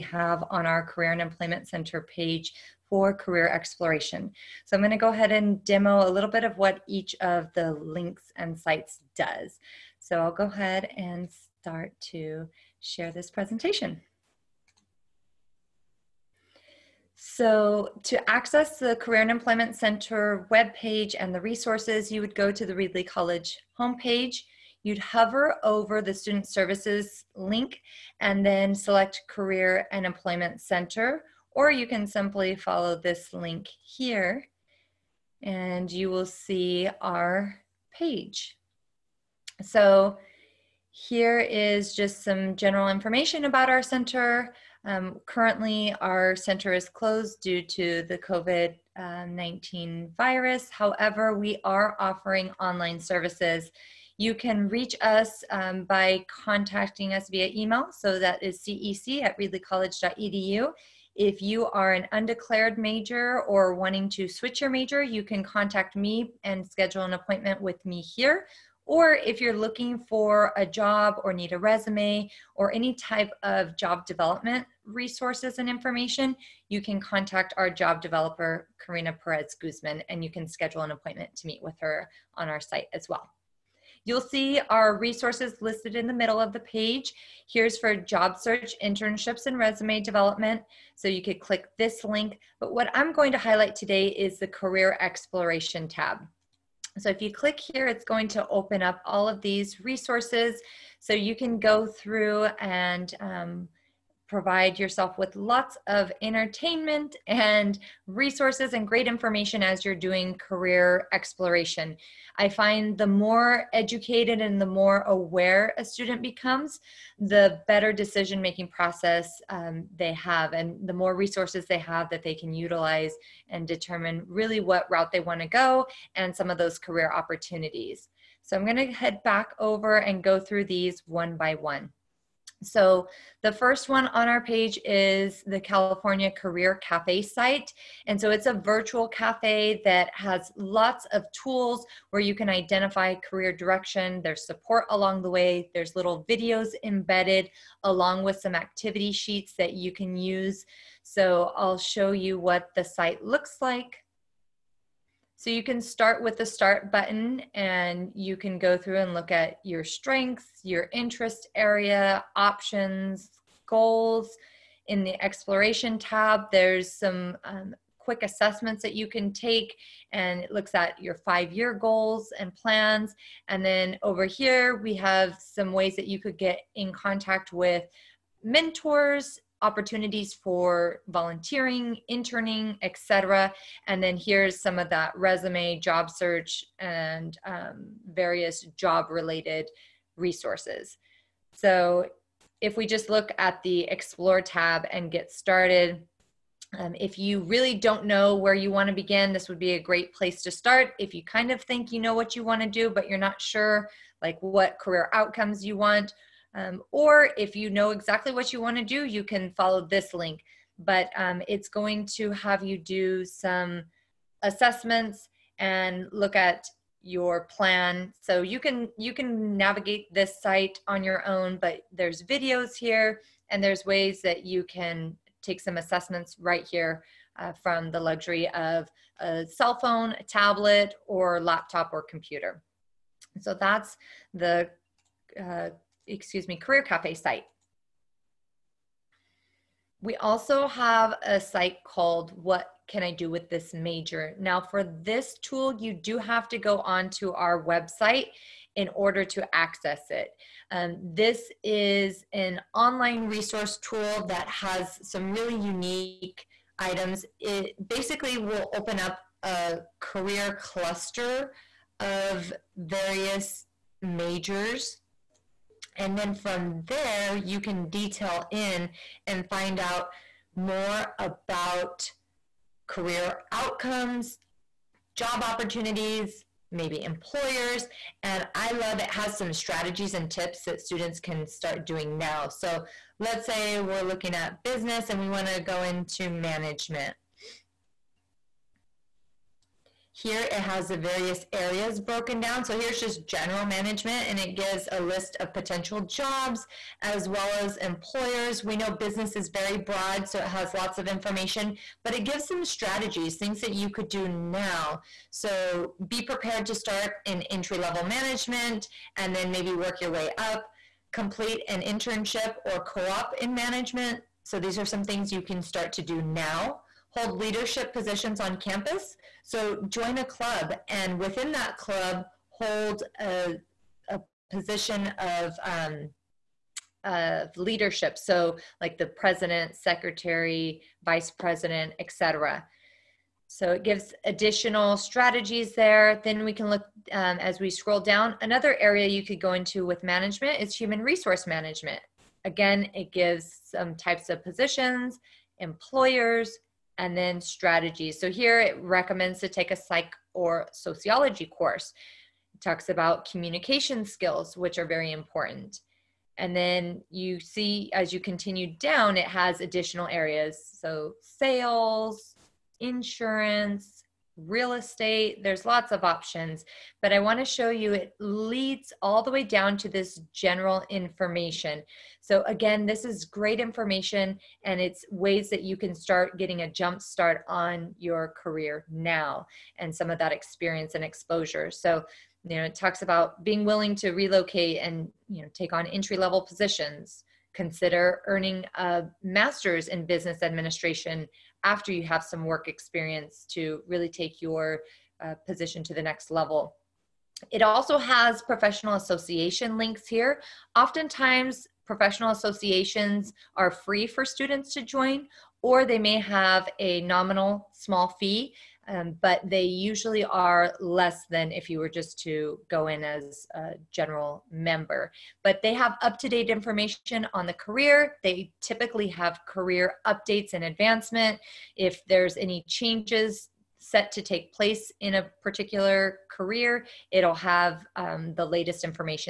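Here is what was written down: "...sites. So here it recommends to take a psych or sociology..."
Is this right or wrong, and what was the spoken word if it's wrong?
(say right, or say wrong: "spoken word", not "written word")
wrong: "strategies", not "sites".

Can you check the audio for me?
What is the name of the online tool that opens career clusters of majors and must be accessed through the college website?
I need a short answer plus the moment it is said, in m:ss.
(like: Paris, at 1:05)
What Can I Do With This Major?, at 4:02.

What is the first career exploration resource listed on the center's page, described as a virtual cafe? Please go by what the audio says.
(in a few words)
California Career Cafe.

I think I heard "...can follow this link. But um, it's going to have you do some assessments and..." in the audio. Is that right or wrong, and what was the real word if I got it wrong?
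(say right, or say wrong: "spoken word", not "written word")
right.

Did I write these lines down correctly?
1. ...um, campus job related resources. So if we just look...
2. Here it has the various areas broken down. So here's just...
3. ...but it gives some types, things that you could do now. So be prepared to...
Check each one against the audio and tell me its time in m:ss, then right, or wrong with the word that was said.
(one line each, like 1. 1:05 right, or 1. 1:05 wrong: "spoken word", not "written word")
1. 3:07 wrong: "various", not "campus"
2. 4:50 right
3. 5:02 wrong: "strategies", not "types".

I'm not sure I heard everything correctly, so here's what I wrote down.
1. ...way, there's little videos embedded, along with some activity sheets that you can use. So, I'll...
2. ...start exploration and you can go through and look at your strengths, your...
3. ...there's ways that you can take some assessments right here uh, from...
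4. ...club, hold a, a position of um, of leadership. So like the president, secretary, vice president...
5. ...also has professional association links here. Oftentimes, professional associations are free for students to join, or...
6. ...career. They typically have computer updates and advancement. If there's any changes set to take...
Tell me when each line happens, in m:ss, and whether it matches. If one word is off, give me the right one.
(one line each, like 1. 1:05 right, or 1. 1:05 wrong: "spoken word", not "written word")
1. 2:25 right
2. 2:36 wrong: "button", not "exploration"
3. 3:43 right
4. 5:21 right
5. 6:37 right
6. 6:57 wrong: "career", not "computer".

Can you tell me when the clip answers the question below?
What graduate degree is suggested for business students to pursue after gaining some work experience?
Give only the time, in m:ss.
6:29.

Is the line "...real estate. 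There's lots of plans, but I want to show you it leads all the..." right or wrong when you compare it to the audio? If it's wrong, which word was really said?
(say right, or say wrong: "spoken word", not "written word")
wrong: "options", not "plans".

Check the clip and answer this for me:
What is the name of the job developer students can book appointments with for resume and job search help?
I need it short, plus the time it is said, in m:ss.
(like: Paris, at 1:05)
Karina Perez Guzman, at 1:18.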